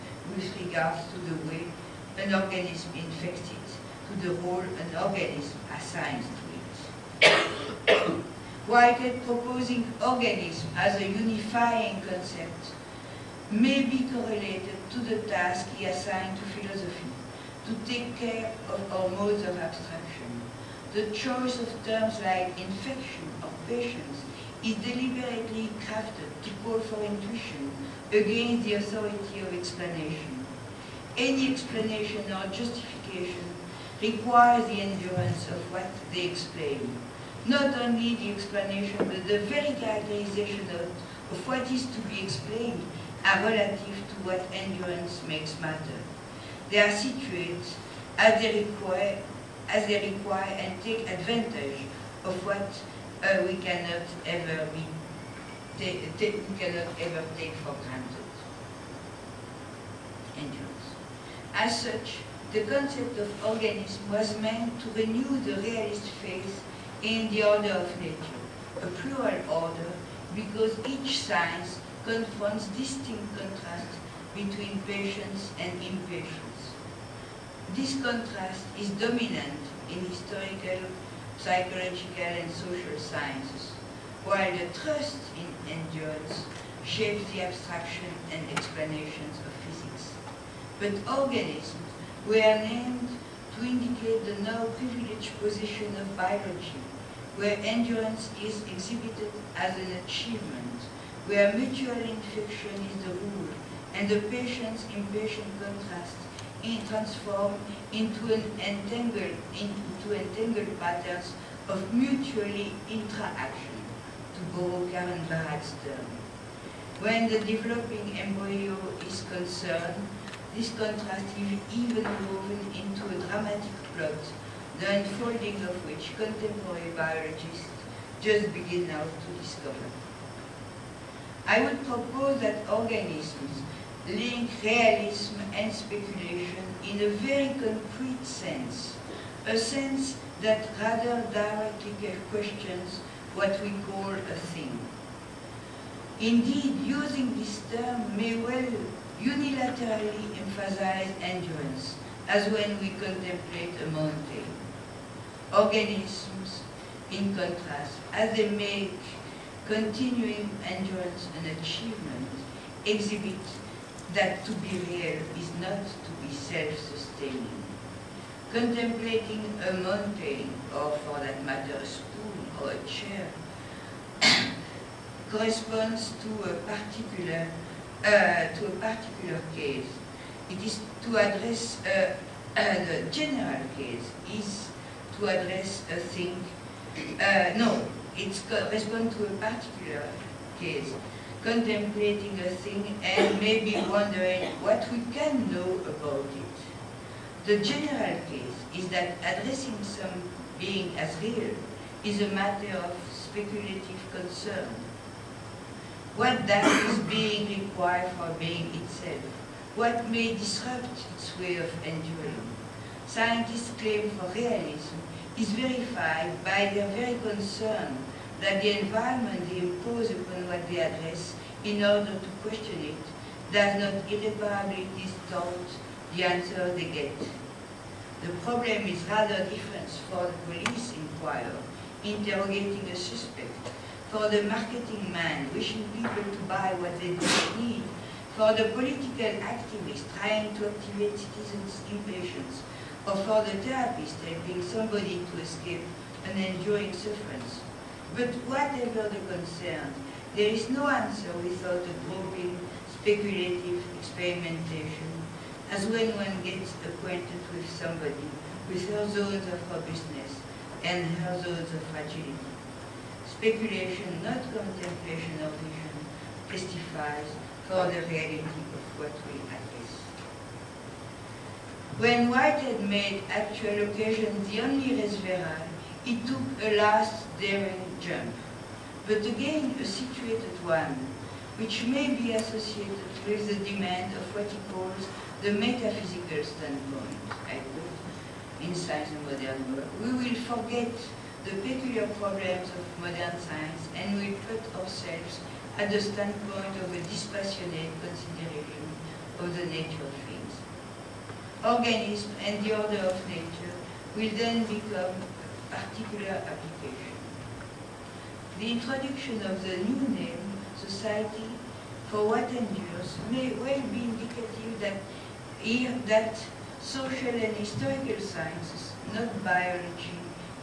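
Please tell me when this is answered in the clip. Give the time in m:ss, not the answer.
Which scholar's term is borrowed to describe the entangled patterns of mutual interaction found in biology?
1:54.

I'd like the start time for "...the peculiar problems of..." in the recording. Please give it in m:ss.
4:51.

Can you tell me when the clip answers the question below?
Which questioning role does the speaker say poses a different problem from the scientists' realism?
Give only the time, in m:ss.
3:50.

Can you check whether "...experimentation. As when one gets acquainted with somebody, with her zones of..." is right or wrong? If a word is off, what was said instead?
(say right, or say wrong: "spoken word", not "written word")
right.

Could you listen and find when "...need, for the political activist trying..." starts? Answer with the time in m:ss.
3:57.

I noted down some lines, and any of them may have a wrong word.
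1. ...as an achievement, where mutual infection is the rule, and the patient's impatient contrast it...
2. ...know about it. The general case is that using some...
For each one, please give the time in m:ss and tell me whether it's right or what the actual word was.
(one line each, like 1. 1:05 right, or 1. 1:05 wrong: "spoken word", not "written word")
1. 1:39 right
2. 3:15 wrong: "addressing", not "using".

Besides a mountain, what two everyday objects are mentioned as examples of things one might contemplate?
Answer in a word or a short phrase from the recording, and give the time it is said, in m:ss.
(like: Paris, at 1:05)
A spoon or a chair, at 2:51.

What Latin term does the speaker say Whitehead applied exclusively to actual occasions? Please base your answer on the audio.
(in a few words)
res verae.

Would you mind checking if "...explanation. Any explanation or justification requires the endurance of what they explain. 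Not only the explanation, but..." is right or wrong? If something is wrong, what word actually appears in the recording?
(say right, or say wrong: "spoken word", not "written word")
right.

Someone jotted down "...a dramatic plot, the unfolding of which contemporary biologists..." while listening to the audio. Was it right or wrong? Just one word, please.
right.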